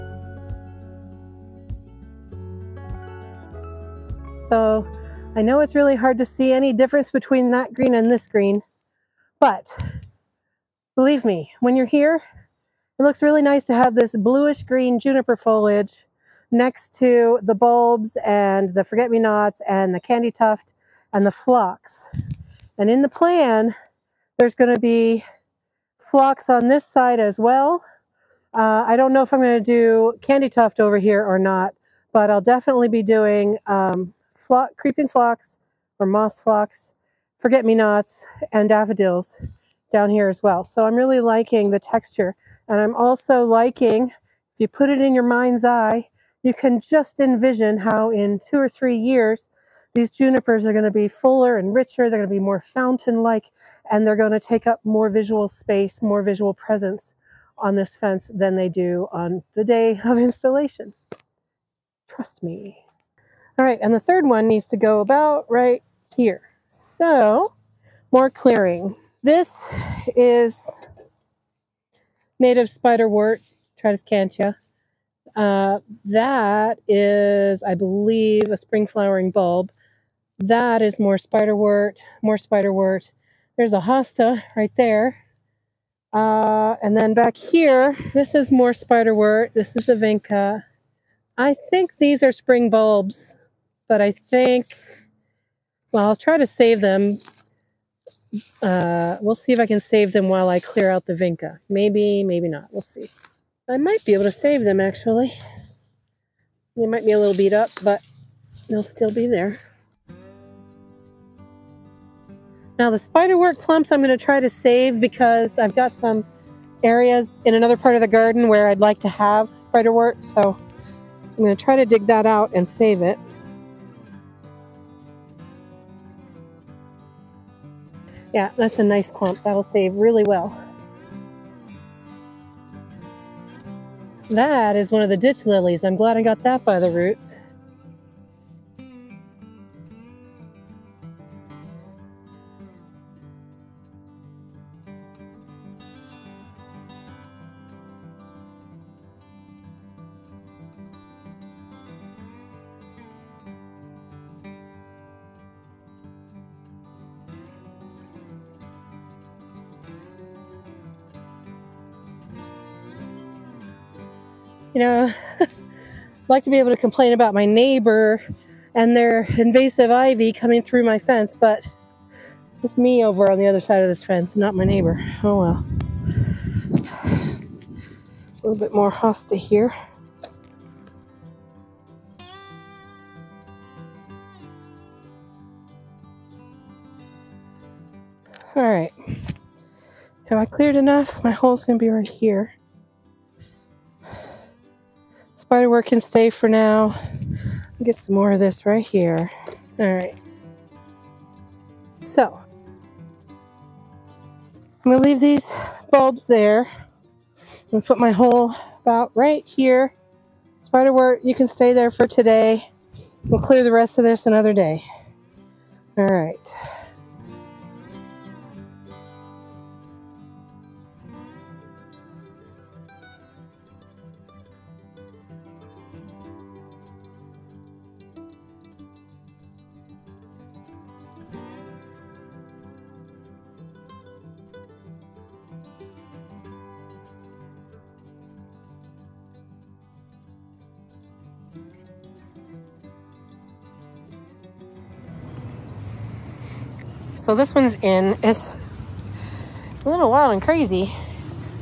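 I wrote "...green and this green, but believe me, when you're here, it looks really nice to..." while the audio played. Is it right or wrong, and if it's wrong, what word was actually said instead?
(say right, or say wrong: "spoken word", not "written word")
right.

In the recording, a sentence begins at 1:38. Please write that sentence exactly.
Uh, we'll see if I can save them while I clear out the Vinca.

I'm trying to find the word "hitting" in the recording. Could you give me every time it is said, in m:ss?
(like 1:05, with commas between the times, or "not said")
not said.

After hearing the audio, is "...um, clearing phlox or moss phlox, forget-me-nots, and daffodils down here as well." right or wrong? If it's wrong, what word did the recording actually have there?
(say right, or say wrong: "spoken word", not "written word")
wrong: "creeping", not "clearing".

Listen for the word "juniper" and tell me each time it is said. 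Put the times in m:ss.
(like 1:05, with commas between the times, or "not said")
0:14, 0:50.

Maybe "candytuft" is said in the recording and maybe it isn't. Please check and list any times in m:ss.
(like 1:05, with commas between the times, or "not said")
0:20, 0:30.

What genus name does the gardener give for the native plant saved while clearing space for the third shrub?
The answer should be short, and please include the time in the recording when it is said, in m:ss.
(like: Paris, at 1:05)
Tradescantia, at 1:13.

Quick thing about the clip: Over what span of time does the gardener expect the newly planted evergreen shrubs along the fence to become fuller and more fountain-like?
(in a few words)
2 or 3 years.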